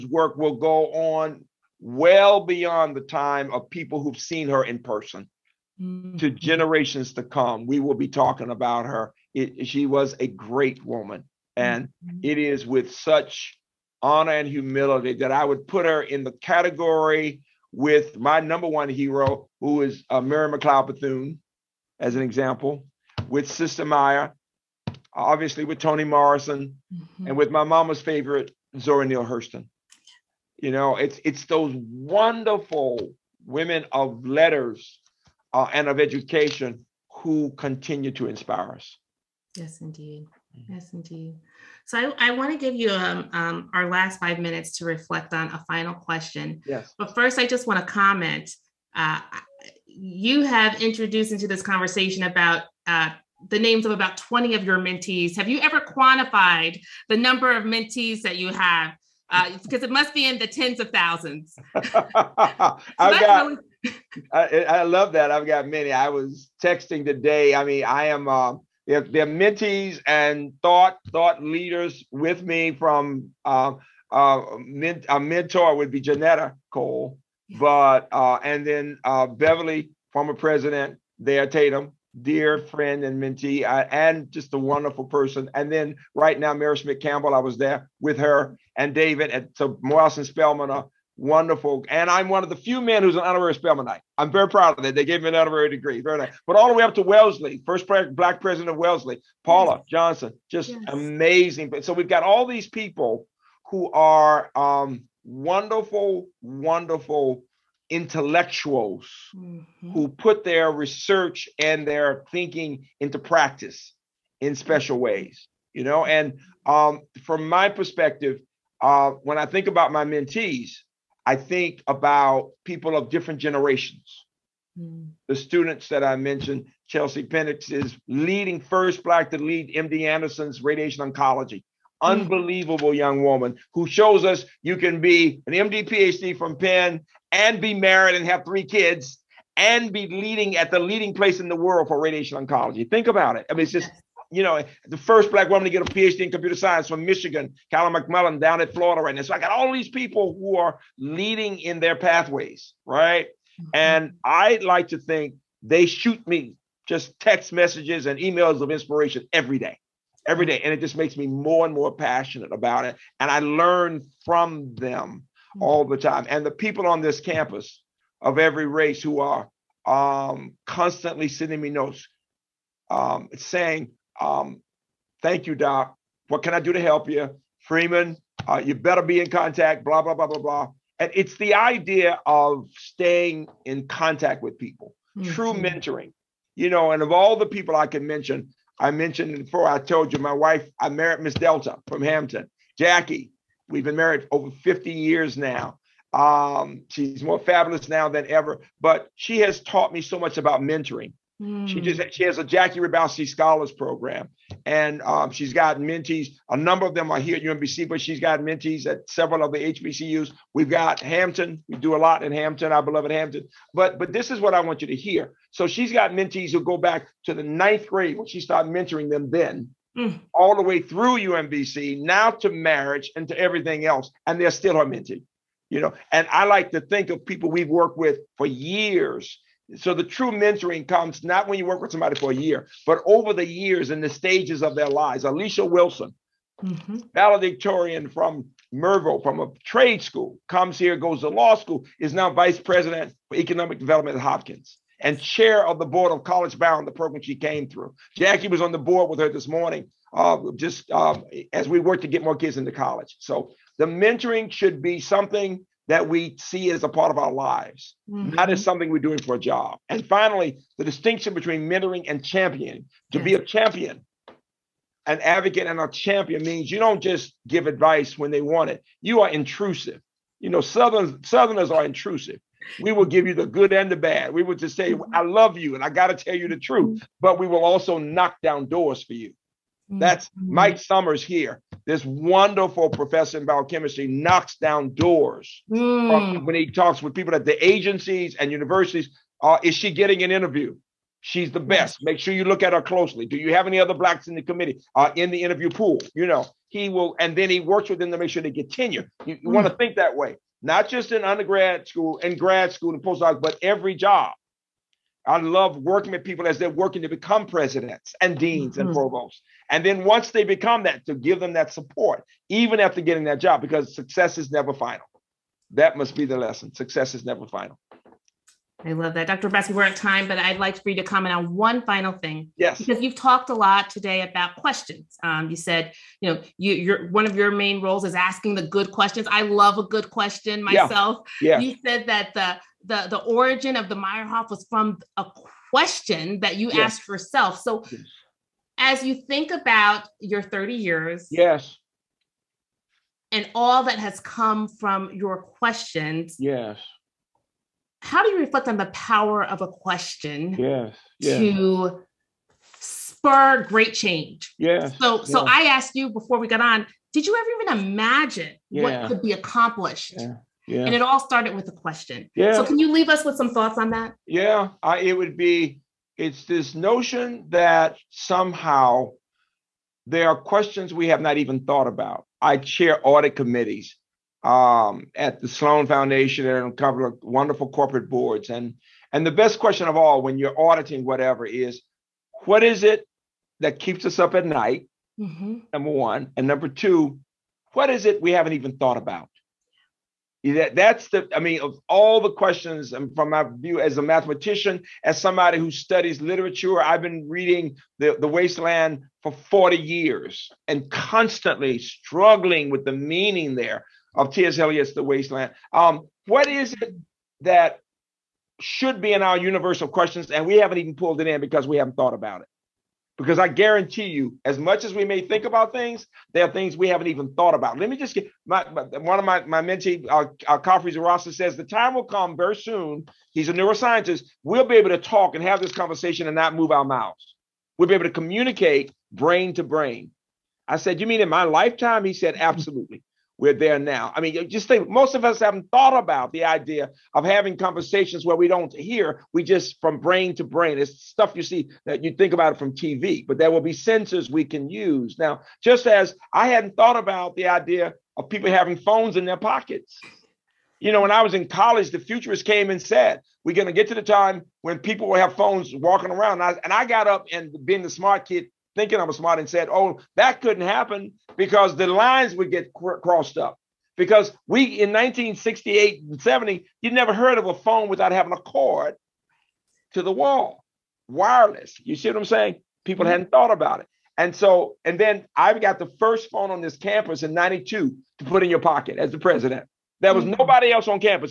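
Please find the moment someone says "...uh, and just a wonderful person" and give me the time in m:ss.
1:23.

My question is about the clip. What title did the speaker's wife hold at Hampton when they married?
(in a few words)
Miss Delta.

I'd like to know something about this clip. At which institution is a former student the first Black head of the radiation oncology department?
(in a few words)
MD Anderson.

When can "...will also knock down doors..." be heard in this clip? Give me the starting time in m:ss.
4:37.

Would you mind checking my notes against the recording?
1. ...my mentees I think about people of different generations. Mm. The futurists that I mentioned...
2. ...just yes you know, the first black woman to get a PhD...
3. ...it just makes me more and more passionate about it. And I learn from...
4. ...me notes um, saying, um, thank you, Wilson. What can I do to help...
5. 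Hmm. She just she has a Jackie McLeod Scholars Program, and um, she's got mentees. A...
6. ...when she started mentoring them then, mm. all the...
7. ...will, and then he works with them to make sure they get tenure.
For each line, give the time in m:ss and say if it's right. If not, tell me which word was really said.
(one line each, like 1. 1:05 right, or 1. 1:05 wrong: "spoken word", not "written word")
1. 1:59 wrong: "students", not "futurists"
2. 2:23 right
3. 2:40 right
4. 2:51 wrong: "Doc", not "Wilson"
5. 3:21 wrong: "Hrabowski", not "McLeod"
6. 3:38 right
7. 4:56 right.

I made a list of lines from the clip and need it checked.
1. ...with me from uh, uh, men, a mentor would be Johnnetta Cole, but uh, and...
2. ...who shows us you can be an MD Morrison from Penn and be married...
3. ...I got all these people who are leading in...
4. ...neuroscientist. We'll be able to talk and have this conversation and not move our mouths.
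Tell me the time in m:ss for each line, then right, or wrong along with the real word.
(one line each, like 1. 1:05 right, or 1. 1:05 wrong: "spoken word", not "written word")
1. 1:12 right
2. 2:13 wrong: "PhD", not "Morrison"
3. 2:29 right
4. 7:03 right.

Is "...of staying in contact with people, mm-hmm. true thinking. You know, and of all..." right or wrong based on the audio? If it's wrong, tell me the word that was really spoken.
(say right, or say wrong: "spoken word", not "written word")
wrong: "mentoring", not "thinking".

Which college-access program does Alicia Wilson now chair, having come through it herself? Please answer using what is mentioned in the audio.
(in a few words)
College Bound.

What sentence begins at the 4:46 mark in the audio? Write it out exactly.
when he talks with people at the agencies and universities.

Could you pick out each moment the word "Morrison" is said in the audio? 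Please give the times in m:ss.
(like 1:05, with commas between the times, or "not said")
0:26, 1:29.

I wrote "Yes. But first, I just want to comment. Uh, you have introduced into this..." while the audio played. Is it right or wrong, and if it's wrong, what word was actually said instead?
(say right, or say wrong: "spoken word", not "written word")
right.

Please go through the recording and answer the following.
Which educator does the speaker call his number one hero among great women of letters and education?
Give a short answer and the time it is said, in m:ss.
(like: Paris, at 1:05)
Mary McLeod Bethune, at 0:20.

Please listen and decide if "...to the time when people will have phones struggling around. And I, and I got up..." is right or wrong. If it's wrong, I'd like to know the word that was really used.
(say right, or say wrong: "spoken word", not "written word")
wrong: "walking", not "struggling".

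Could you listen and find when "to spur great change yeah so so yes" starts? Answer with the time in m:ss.
5:51.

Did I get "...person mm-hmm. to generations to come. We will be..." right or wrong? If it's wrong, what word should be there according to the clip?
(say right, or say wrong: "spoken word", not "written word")
right.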